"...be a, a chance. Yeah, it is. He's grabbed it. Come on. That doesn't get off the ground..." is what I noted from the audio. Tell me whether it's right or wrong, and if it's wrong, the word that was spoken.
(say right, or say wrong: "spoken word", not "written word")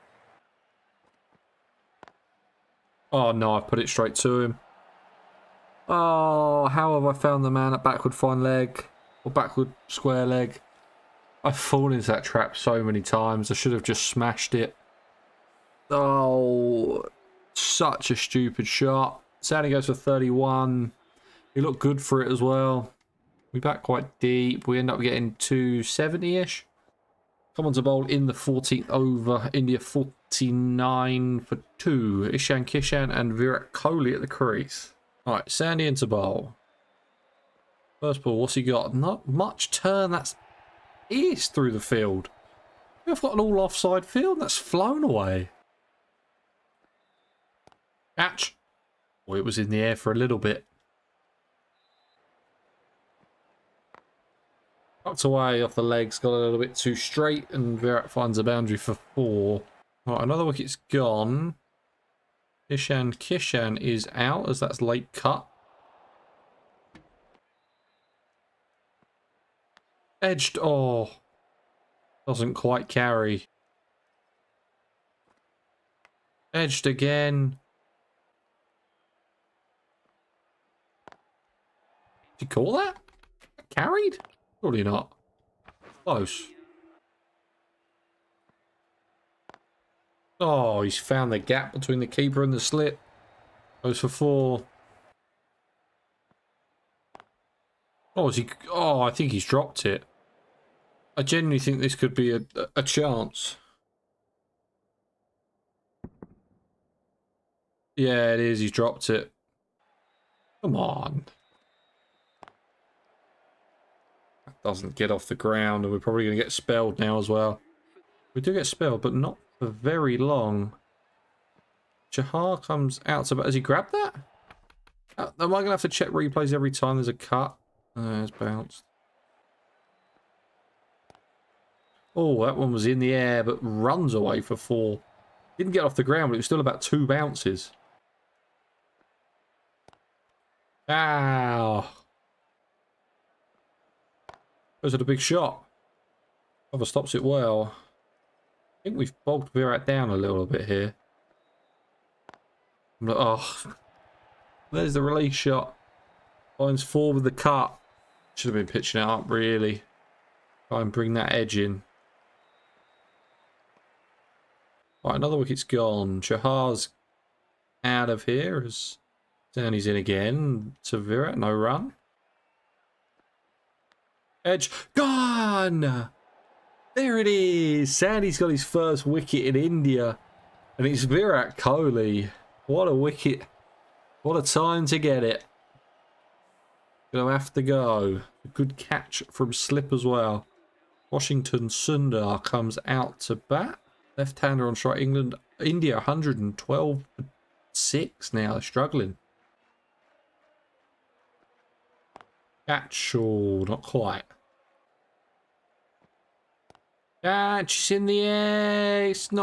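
wrong: "dropped", not "grabbed".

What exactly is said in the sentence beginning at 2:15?
Didn't get off the ground, but it was still about two bounces.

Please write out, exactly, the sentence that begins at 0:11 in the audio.
I've fallen into that trap so many times.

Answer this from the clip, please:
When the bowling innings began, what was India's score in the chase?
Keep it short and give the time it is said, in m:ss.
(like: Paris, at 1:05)
49 for 2, at 0:29.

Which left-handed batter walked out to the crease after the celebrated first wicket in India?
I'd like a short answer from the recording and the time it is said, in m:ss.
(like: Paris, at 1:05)
Washington Sundar, at 3:11.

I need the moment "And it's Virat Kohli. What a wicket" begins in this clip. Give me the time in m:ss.
3:00.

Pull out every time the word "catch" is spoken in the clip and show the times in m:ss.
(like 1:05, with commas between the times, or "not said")
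0:48, 3:08, 3:22.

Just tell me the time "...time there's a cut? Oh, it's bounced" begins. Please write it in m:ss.
2:06.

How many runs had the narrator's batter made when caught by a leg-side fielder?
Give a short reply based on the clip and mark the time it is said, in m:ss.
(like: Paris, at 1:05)
31, at 0:19.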